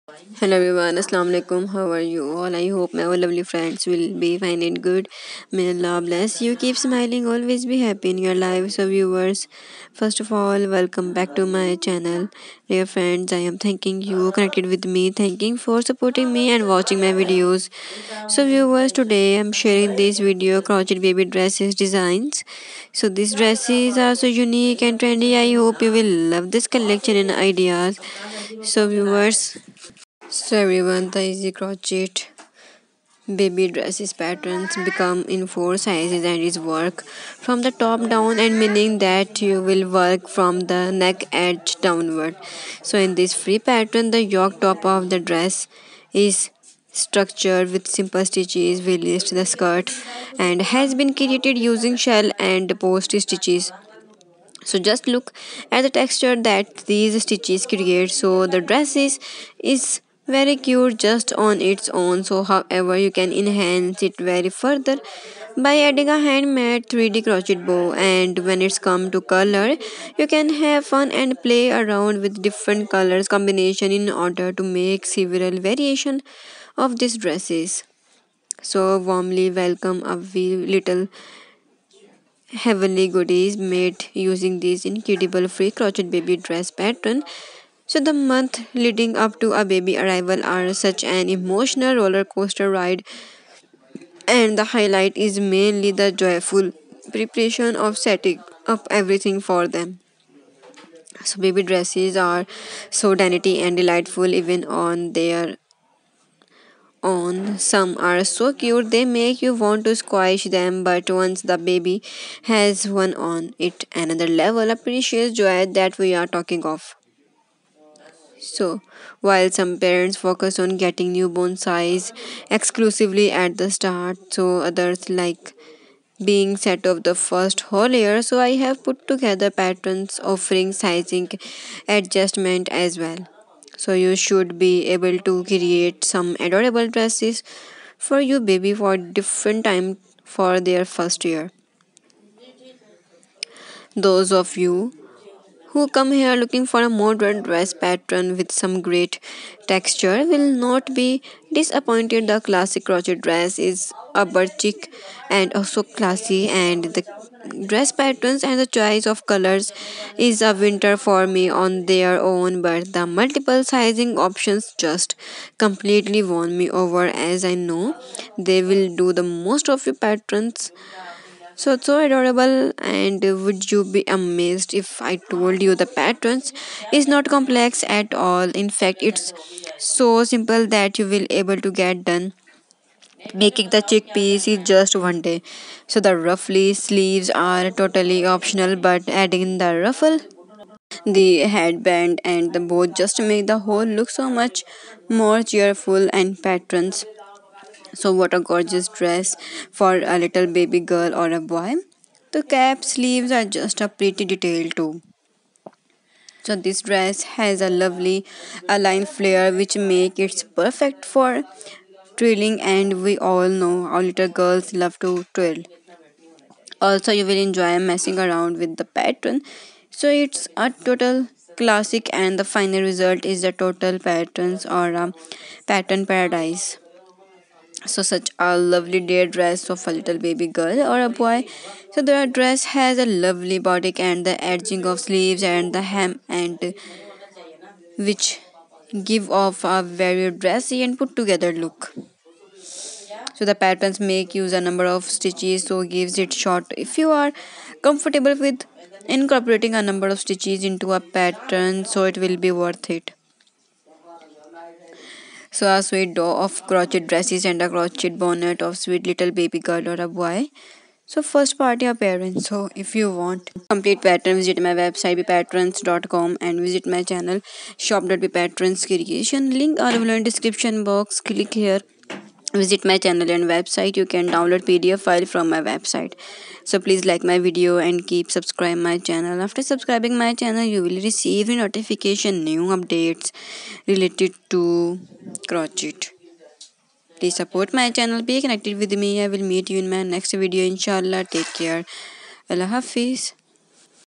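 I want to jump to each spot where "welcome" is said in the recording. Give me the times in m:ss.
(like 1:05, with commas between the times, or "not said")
0:10, 1:19.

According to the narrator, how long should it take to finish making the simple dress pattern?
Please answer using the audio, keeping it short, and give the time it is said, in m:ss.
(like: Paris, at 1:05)
One day, at 3:04.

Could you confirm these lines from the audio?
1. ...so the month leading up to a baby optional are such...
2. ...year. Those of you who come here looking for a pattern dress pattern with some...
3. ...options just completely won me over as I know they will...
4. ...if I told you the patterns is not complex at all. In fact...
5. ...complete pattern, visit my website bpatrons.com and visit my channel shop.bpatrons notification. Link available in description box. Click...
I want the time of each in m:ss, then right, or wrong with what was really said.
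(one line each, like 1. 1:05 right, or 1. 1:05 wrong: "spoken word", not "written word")
1. 1:27 wrong: "arrival", not "optional"
2. 2:21 wrong: "modern", not "pattern"
3. 2:44 right
4. 2:54 right
5. 4:23 wrong: "creation", not "notification".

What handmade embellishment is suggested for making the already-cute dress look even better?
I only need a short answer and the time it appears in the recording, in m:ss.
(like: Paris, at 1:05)
3D crochet bow, at 1:06.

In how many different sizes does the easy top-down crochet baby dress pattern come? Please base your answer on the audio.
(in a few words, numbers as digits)
4.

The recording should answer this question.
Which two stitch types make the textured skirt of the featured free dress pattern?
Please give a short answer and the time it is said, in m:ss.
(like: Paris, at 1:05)
Shell and post stitches, at 0:51.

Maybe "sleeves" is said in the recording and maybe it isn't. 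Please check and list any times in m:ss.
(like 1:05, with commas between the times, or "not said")
3:06, 3:22, 3:54.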